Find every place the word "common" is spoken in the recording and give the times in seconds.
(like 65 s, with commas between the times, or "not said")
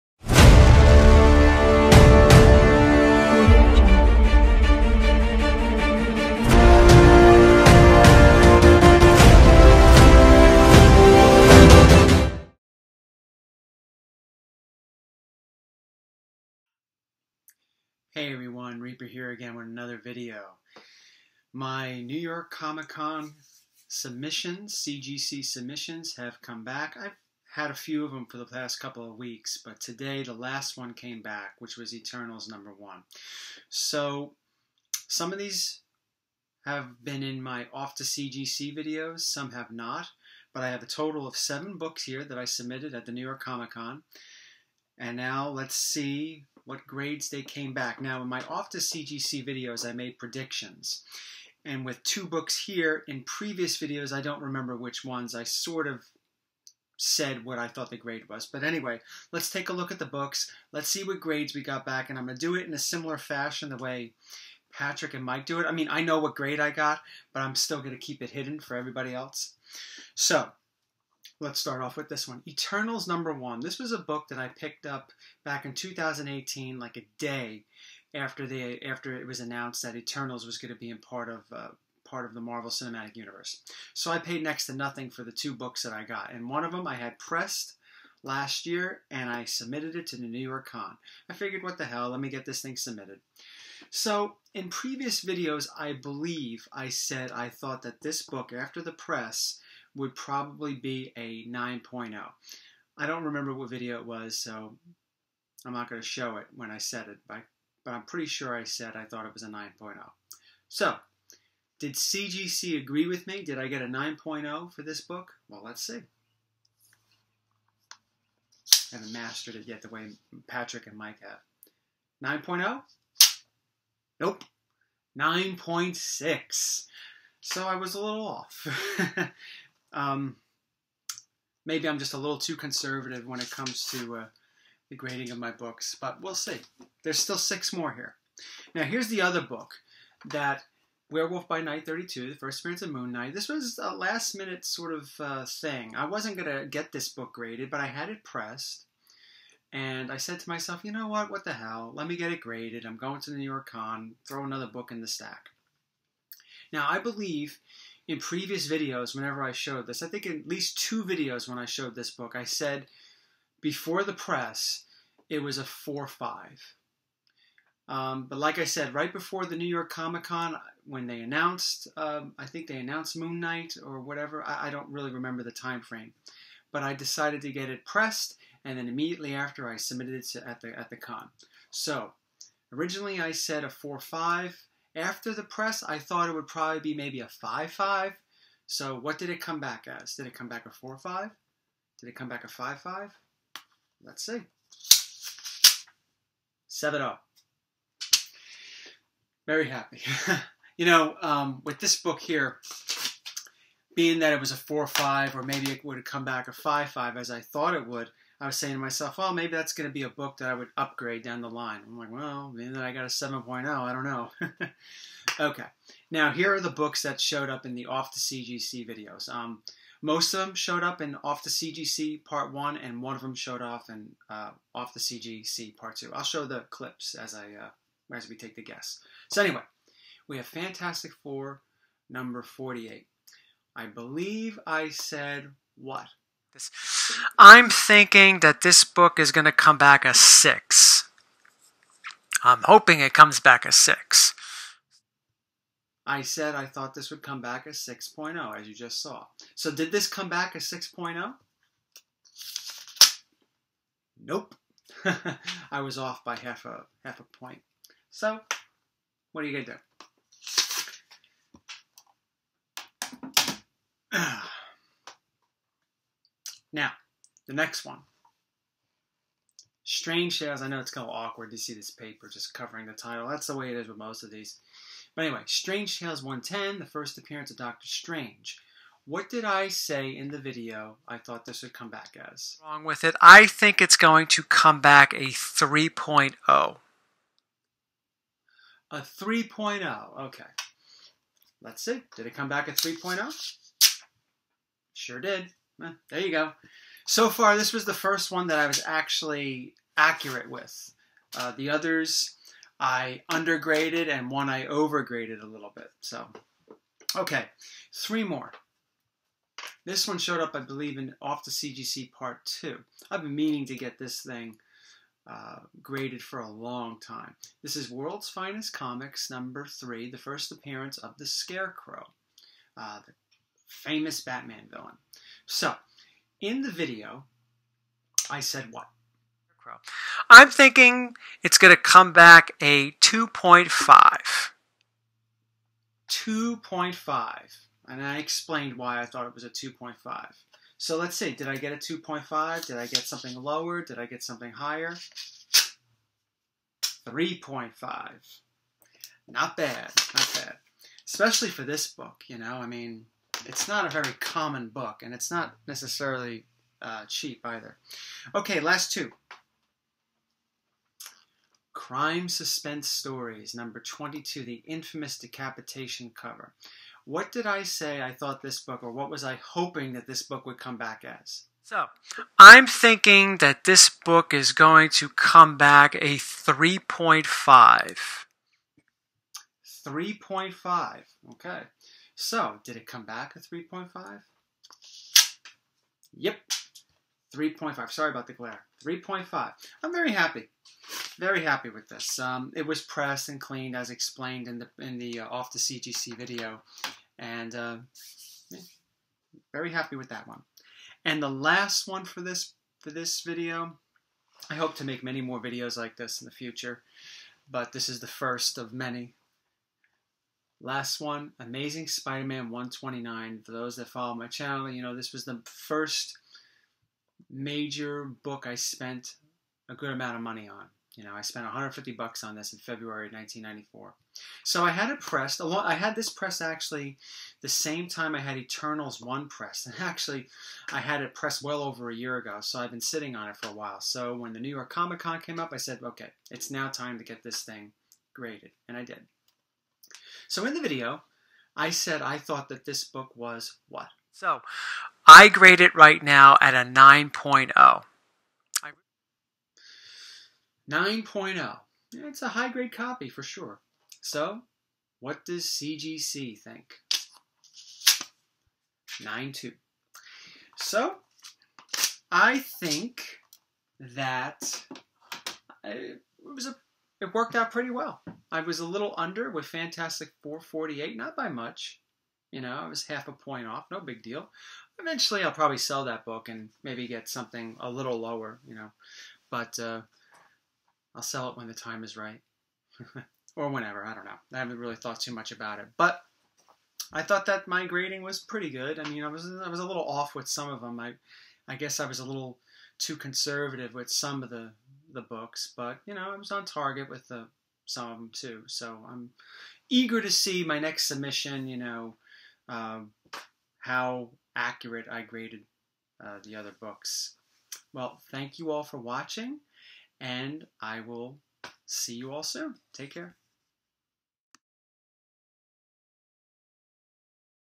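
354 s.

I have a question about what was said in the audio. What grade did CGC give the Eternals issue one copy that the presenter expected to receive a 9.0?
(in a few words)
9.6.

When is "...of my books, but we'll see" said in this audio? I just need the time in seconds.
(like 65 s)
135 s.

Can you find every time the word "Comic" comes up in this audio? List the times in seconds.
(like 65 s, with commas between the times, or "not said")
22 s, 43 s, 169 s, 318 s, 434 s.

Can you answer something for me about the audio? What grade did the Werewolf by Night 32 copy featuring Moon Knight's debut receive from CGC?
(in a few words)
7.0.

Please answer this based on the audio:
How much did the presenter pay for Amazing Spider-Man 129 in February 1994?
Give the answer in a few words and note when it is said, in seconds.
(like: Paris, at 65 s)
$150, at 421 s.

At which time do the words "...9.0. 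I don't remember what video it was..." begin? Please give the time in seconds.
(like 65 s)
101 s.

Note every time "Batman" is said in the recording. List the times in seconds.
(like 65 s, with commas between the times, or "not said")
324 s.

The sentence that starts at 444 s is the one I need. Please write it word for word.
So I grade it right now at a 9.0.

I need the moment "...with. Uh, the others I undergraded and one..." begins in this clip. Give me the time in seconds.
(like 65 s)
300 s.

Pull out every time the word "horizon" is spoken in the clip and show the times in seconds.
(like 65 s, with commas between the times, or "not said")
not said.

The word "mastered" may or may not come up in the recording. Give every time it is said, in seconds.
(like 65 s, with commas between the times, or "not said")
119 s.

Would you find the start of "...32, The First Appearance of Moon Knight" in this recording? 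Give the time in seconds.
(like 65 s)
141 s.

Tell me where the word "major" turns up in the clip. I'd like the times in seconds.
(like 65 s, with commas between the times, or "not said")
417 s.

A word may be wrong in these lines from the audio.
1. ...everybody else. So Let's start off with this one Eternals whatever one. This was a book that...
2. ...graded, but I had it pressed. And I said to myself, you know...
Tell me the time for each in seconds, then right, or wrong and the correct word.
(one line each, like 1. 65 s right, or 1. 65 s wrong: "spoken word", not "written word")
1. 68 s wrong: "number", not "whatever"
2. 147 s right.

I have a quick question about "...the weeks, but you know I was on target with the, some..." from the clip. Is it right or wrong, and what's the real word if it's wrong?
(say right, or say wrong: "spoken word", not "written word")
wrong: "books", not "weeks".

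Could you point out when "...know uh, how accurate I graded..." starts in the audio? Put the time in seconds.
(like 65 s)
501 s.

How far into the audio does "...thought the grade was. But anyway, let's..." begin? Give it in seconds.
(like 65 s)
57 s.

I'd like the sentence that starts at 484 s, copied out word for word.
I haven't really thought too much about it.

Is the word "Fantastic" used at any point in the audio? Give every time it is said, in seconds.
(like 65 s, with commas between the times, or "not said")
230 s, 469 s.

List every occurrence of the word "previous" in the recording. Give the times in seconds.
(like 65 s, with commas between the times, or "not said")
53 s, 94 s, 158 s.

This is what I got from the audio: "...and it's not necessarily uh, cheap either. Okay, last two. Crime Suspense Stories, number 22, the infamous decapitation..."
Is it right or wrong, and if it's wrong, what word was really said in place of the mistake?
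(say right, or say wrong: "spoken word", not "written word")
right.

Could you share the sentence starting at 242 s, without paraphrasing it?
I'm hoping it comes back a six.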